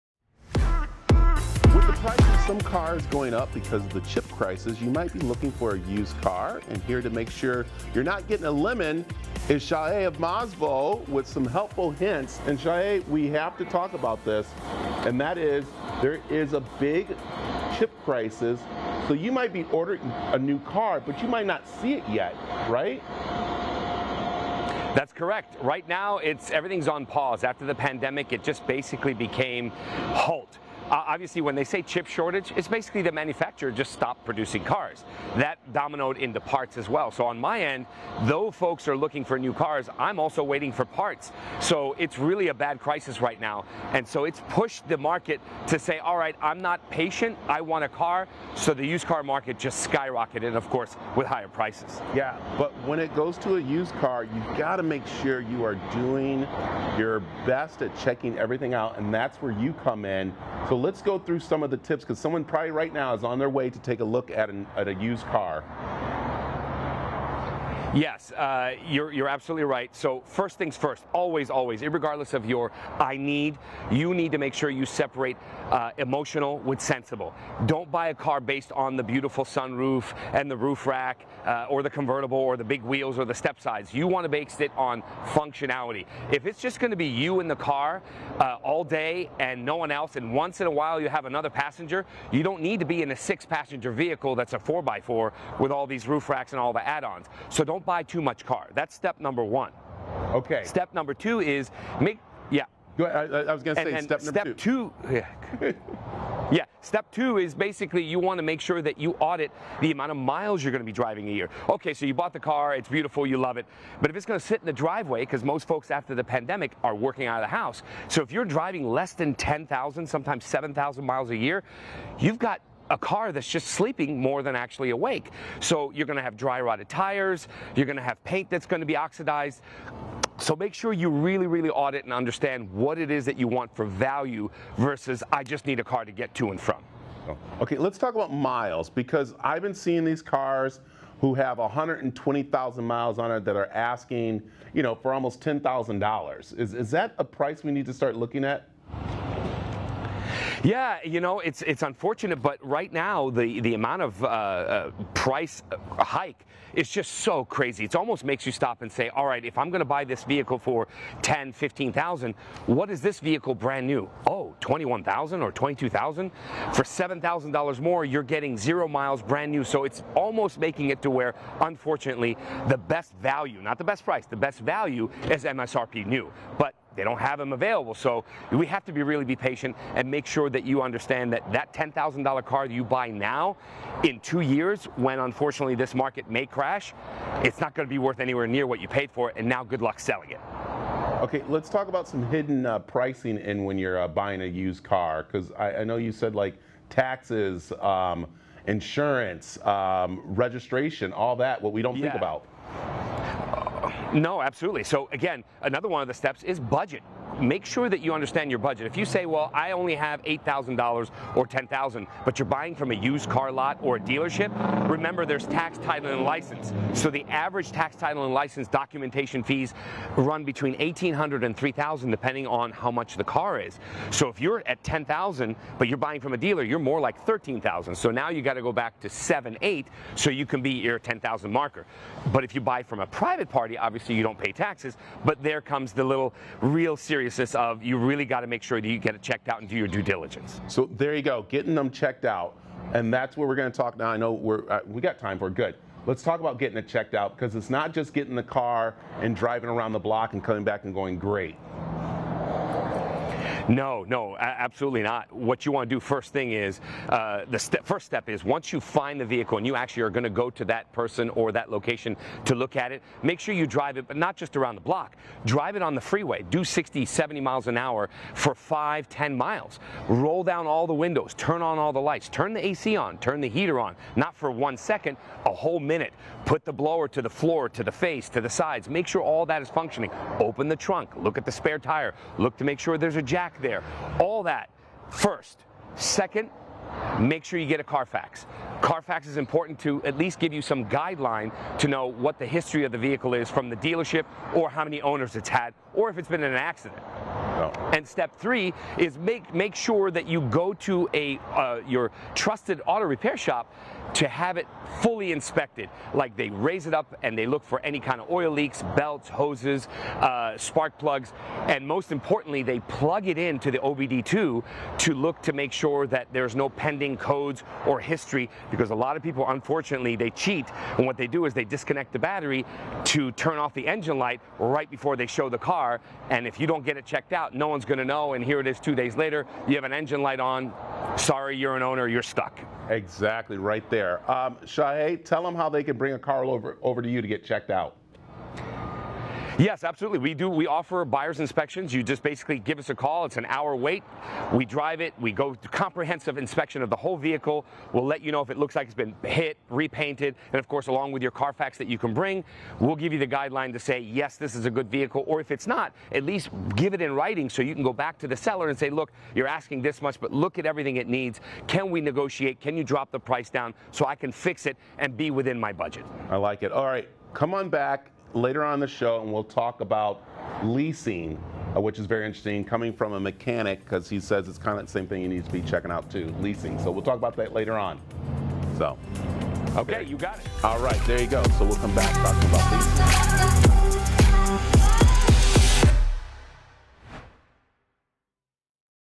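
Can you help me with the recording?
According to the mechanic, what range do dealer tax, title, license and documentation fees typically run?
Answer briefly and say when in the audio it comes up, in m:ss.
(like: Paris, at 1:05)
$1,800 to $3,000, at 3:40.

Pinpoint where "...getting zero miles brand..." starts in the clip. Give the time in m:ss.
2:48.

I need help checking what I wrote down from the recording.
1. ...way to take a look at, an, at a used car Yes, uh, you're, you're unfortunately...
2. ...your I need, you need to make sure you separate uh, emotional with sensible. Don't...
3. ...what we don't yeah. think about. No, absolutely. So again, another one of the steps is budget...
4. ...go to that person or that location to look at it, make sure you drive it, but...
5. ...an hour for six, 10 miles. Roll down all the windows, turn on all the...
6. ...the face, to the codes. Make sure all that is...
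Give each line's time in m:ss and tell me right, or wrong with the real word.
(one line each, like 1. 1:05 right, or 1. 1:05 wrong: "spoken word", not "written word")
1. 1:03 wrong: "absolutely", not "unfortunately"
2. 1:12 right
3. 3:21 right
4. 4:20 right
5. 4:27 wrong: "five", not "six"
6. 4:37 wrong: "sides", not "codes".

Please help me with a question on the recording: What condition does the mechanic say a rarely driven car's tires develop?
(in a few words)
dry rotted.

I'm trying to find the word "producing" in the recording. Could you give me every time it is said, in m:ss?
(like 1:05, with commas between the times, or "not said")
0:34.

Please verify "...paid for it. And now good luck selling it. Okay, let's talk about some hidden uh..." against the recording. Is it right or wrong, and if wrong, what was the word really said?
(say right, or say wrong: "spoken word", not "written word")
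right.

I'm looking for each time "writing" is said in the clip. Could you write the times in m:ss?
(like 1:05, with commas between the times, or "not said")
5:57.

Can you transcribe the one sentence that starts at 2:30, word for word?
Yeah, you know, it's it's unfortunate, but right now the the amount of uh, uh, price uh, hike is just so crazy.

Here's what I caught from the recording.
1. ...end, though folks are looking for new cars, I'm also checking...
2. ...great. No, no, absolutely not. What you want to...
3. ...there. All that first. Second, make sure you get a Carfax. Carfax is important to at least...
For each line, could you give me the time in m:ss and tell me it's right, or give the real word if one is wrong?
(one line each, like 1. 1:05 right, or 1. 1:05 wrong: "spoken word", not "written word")
1. 0:37 wrong: "waiting", not "checking"
2. 4:11 right
3. 4:43 right.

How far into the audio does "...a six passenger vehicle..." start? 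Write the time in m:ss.
1:33.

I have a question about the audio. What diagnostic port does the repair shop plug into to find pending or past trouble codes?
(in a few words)
OBD2.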